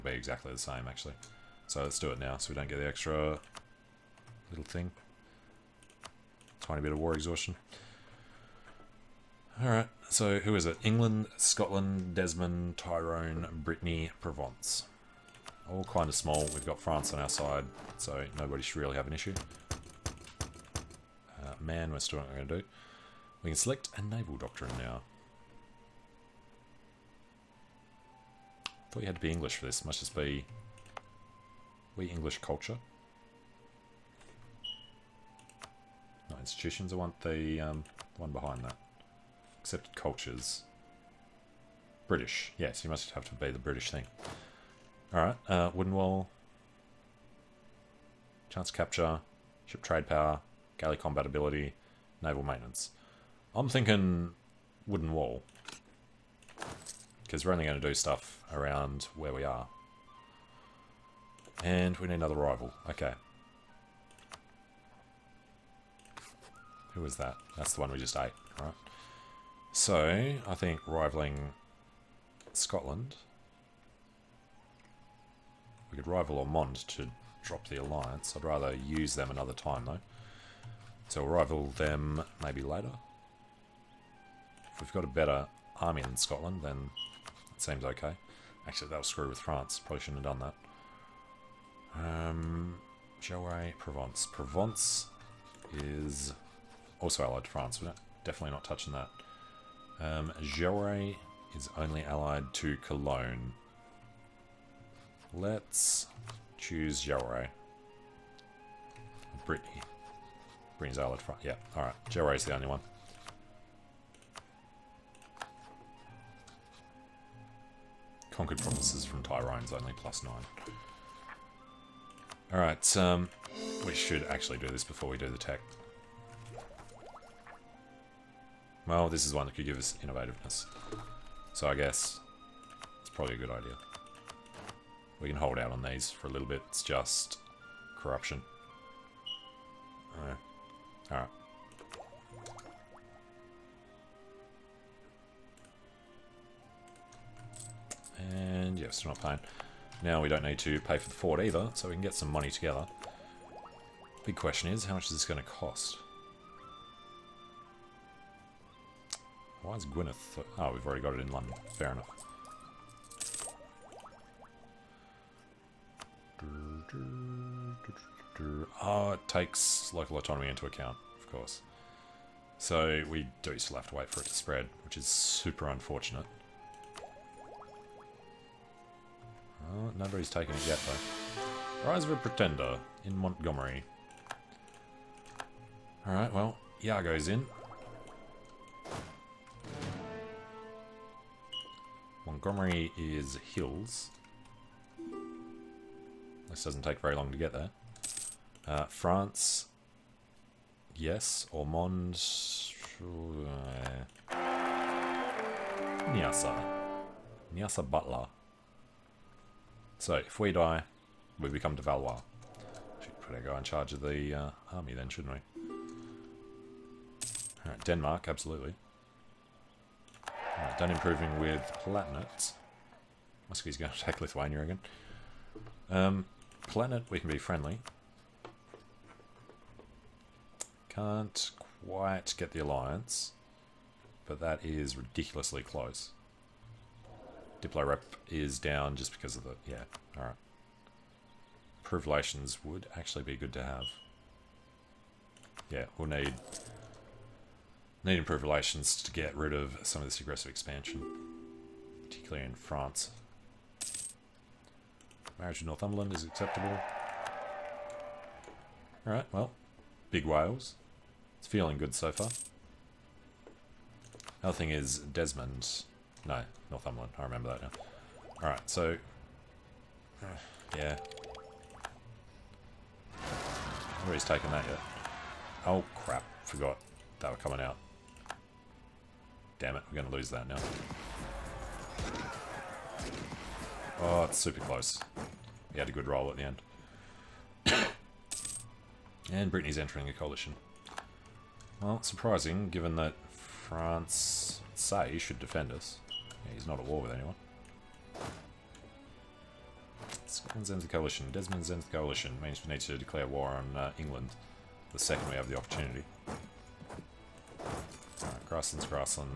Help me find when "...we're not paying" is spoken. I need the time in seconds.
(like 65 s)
149 s.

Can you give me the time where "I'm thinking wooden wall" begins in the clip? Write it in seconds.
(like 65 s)
53 s.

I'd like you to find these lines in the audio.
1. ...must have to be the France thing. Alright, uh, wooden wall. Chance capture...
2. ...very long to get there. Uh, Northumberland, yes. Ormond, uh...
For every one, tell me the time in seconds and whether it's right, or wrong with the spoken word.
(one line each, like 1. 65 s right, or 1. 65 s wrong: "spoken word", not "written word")
1. 42 s wrong: "British", not "France"
2. 196 s wrong: "France", not "Northumberland".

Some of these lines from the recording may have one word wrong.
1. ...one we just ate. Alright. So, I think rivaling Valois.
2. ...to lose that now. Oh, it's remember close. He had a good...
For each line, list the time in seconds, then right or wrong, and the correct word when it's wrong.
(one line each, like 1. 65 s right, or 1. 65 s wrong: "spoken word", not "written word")
1. 67 s wrong: "Scotland", not "Valois"
2. 280 s wrong: "super", not "remember".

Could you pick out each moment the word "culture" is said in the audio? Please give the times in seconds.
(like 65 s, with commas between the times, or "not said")
32 s, 39 s.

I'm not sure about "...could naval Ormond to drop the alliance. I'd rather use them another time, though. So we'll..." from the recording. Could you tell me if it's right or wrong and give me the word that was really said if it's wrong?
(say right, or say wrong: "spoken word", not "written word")
wrong: "rival", not "naval".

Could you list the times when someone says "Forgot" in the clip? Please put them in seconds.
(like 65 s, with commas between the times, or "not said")
276 s.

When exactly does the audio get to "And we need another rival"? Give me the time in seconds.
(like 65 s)
61 s.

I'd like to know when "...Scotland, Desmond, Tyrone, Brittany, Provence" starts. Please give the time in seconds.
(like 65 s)
11 s.